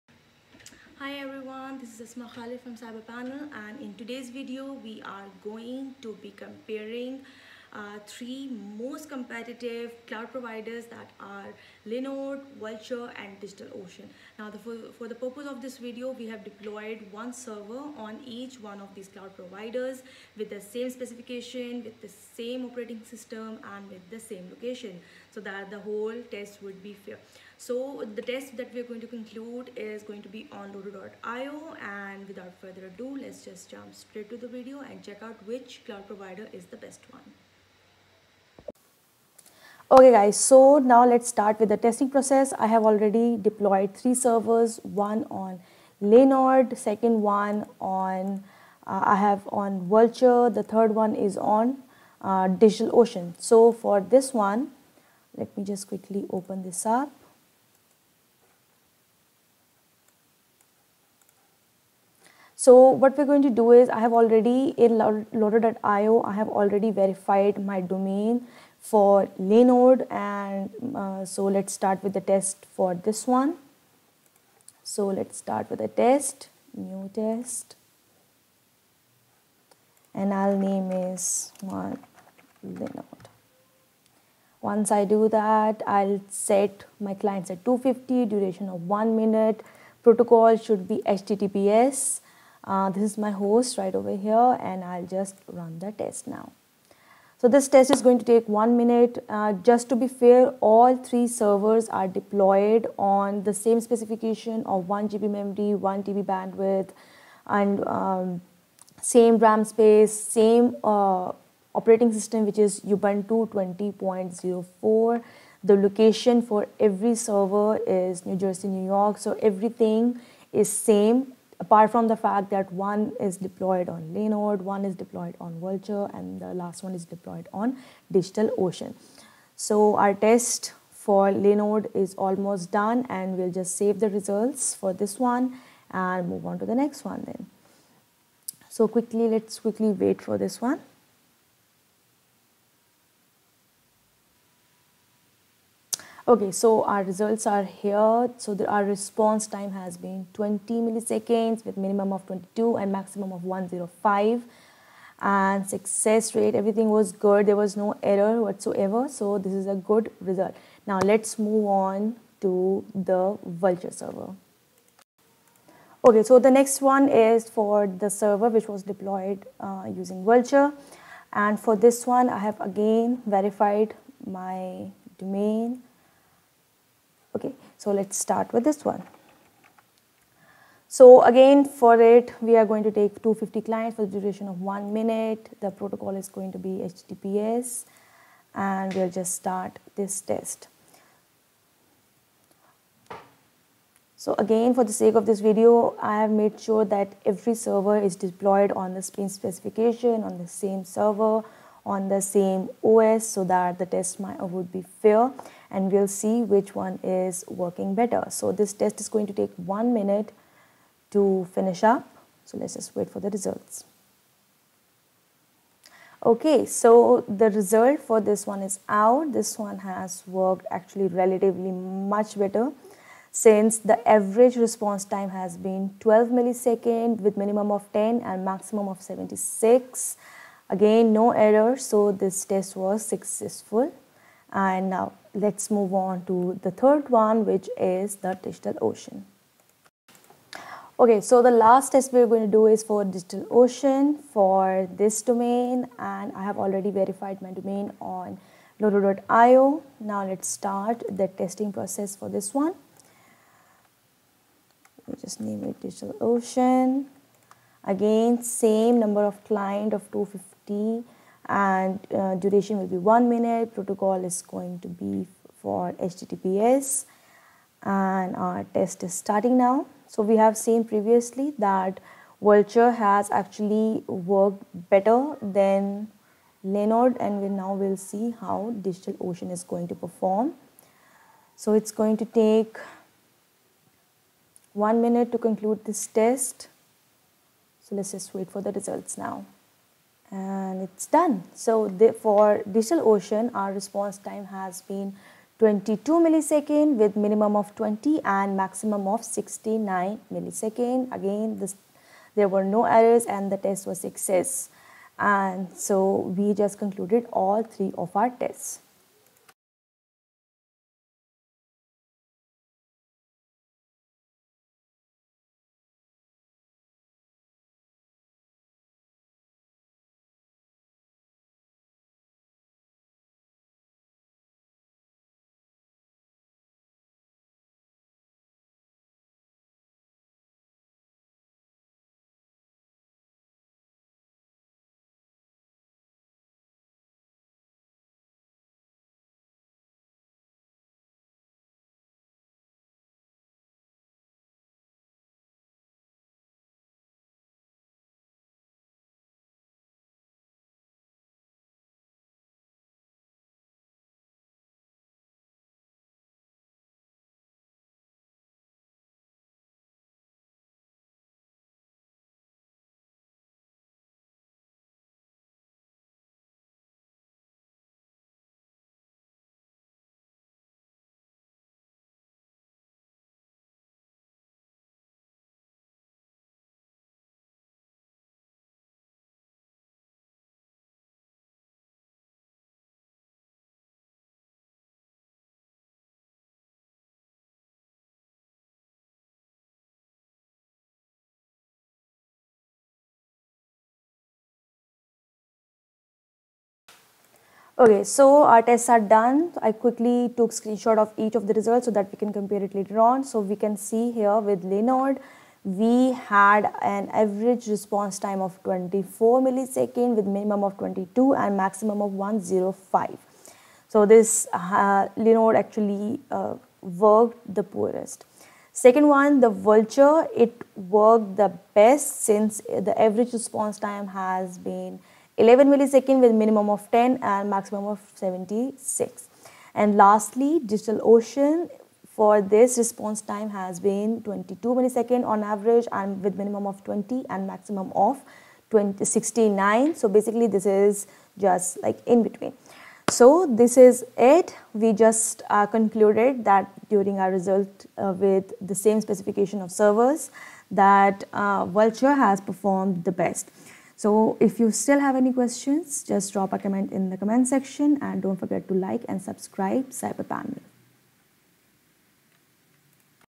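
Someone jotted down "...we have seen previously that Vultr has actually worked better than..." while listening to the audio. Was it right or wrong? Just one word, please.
right.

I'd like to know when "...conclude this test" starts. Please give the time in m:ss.
4:45.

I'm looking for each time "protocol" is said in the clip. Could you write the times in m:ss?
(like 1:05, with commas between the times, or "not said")
1:30, 3:05, 4:23.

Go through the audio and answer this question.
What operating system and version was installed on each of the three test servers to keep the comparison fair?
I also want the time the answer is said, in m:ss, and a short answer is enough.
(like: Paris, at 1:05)
Ubuntu 20.04, at 1:52.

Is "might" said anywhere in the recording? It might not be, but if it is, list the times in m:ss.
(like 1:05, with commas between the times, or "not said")
3:24.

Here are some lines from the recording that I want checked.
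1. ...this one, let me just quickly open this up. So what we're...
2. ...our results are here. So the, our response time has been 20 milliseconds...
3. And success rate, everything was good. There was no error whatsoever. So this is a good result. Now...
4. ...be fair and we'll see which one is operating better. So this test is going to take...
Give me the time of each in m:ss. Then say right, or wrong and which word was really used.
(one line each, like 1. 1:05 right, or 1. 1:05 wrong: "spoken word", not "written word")
1. 0:54 right
2. 2:26 right
3. 2:35 right
4. 3:24 wrong: "working", not "operating".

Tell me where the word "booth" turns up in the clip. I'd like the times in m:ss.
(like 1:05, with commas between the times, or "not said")
not said.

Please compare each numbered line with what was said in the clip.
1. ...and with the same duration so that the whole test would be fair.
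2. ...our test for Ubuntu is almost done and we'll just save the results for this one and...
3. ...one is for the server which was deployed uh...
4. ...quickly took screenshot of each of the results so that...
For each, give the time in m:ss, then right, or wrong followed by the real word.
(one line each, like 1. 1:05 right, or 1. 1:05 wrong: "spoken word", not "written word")
1. 0:23 wrong: "location", not "duration"
2. 2:09 wrong: "Linode", not "Ubuntu"
3. 2:46 right
4. 6:39 right.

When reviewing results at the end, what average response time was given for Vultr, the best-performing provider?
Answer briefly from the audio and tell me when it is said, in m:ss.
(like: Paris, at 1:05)
11 milliseconds, at 7:05.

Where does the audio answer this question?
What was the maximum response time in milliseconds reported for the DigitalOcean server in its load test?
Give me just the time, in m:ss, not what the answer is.
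4:58.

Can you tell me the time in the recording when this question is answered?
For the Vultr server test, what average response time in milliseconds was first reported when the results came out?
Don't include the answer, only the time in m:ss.
3:46.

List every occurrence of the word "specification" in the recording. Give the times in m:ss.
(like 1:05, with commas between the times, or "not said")
0:20, 1:43, 3:19, 7:28.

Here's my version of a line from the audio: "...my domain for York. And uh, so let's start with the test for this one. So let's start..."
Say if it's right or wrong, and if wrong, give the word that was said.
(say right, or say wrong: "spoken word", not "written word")
wrong: "Linode", not "York".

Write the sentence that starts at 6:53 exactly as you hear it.
So this uh, Linode actually uh, worked the poorest.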